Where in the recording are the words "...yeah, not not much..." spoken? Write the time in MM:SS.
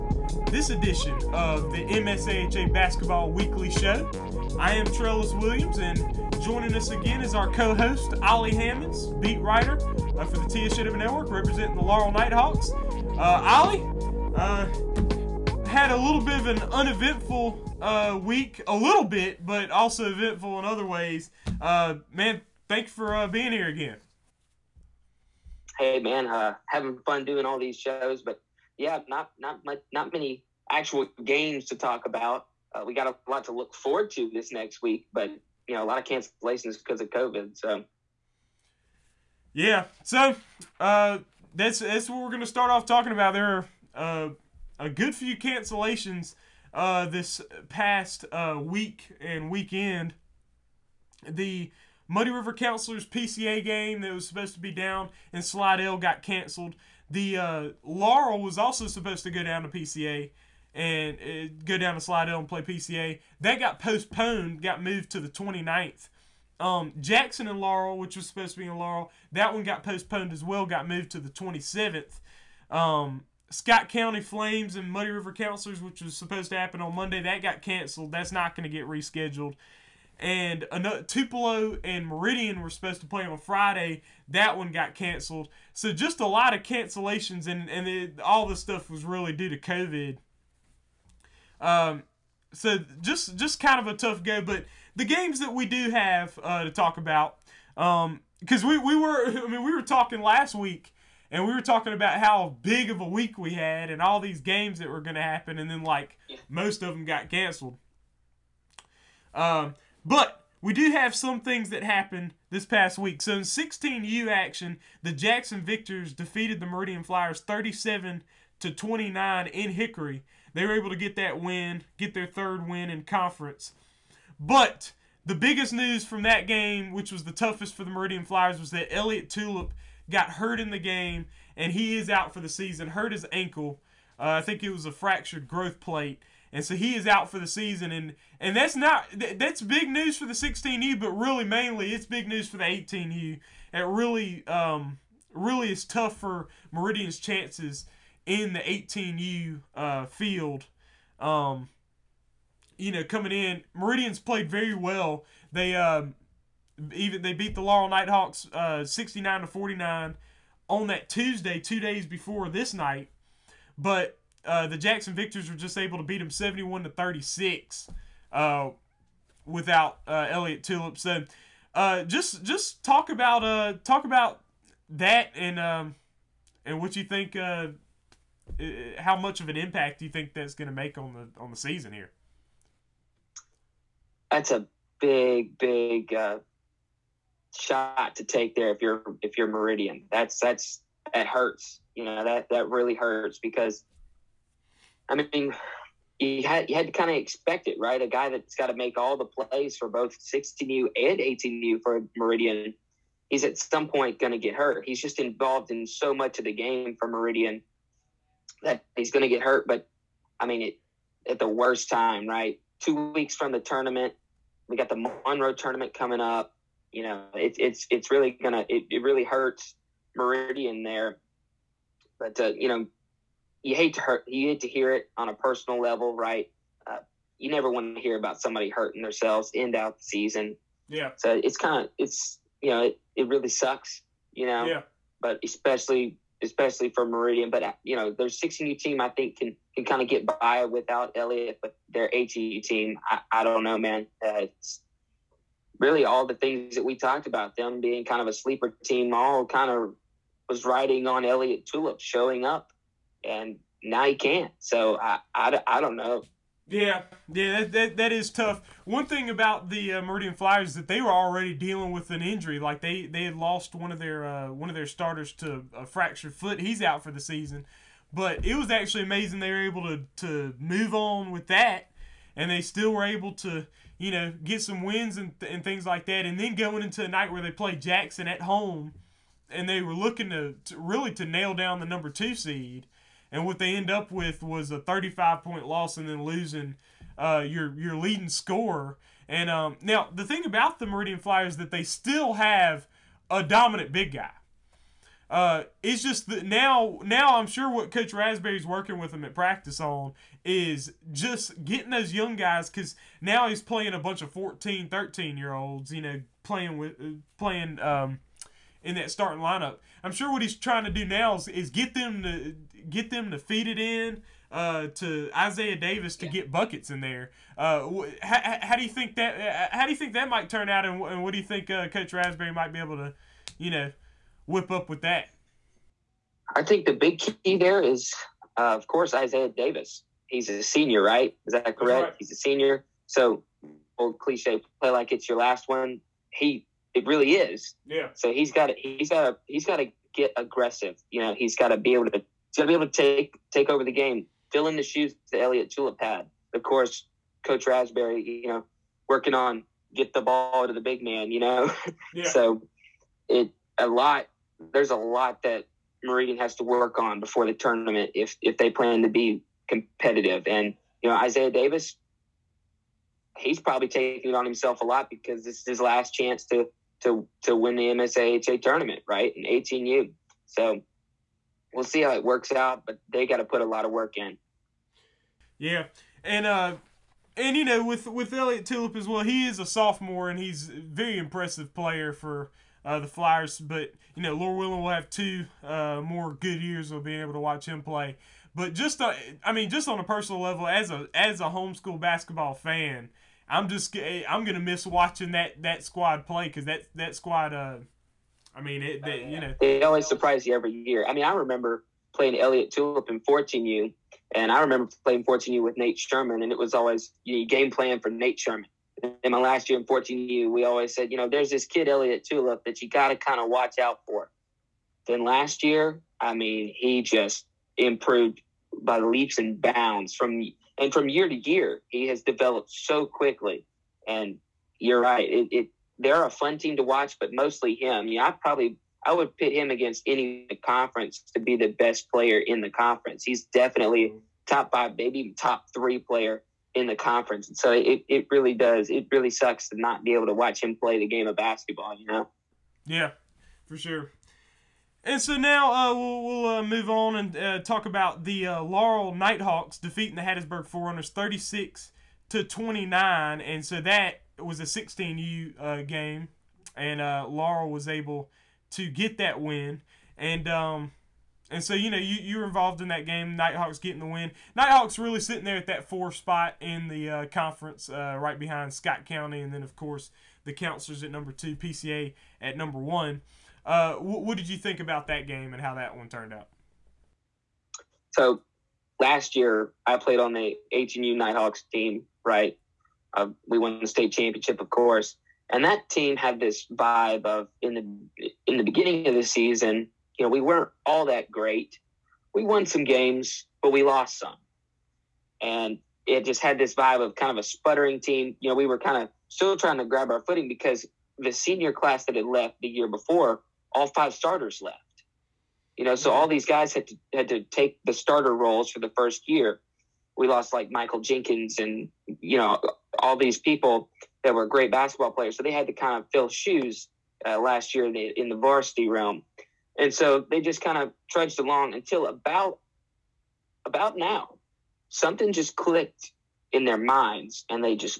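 00:28.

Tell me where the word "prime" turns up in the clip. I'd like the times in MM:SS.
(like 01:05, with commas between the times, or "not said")
not said.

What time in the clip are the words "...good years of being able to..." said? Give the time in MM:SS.
06:26.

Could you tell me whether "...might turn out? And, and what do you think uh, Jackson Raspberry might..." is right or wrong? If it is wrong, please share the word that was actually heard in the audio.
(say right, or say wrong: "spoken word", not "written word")
wrong: "Coach", not "Jackson".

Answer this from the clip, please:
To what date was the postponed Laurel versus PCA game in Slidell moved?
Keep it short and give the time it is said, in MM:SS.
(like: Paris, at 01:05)
the 29th, at 01:05.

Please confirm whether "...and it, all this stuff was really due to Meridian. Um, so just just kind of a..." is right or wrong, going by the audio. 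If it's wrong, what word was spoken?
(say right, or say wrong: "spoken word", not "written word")
wrong: "COVID", not "Meridian".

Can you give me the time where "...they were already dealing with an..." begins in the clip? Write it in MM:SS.
04:20.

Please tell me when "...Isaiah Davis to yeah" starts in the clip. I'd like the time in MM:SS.
05:15.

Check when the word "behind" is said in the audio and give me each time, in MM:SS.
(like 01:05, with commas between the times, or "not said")
07:48.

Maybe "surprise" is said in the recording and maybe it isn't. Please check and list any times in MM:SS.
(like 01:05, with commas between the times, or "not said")
06:40.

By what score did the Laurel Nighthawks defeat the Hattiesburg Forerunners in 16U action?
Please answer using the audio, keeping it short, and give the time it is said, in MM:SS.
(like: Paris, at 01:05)
36 to 29, at 07:31.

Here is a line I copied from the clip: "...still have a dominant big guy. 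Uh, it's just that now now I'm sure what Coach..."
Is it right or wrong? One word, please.
right.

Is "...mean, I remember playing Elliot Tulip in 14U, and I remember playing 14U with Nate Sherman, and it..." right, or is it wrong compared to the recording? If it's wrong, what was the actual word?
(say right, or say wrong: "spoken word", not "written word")
right.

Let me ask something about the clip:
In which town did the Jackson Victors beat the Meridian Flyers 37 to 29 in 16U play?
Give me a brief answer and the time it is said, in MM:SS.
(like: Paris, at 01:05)
Hickory, at 01:59.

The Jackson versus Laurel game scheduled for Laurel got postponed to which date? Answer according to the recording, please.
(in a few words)
the 27th.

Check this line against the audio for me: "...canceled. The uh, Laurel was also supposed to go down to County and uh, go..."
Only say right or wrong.
wrong.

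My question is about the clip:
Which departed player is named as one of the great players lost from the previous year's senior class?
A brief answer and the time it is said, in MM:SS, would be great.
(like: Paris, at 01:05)
Michael Jenkins, at 08:30.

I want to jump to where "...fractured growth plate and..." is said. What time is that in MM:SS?
02:14.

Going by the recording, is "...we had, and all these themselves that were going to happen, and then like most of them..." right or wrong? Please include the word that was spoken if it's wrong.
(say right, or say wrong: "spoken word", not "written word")
wrong: "games", not "themselves".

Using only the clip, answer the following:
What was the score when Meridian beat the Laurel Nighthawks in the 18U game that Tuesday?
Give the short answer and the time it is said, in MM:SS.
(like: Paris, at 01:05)
69 to 49, at 02:38.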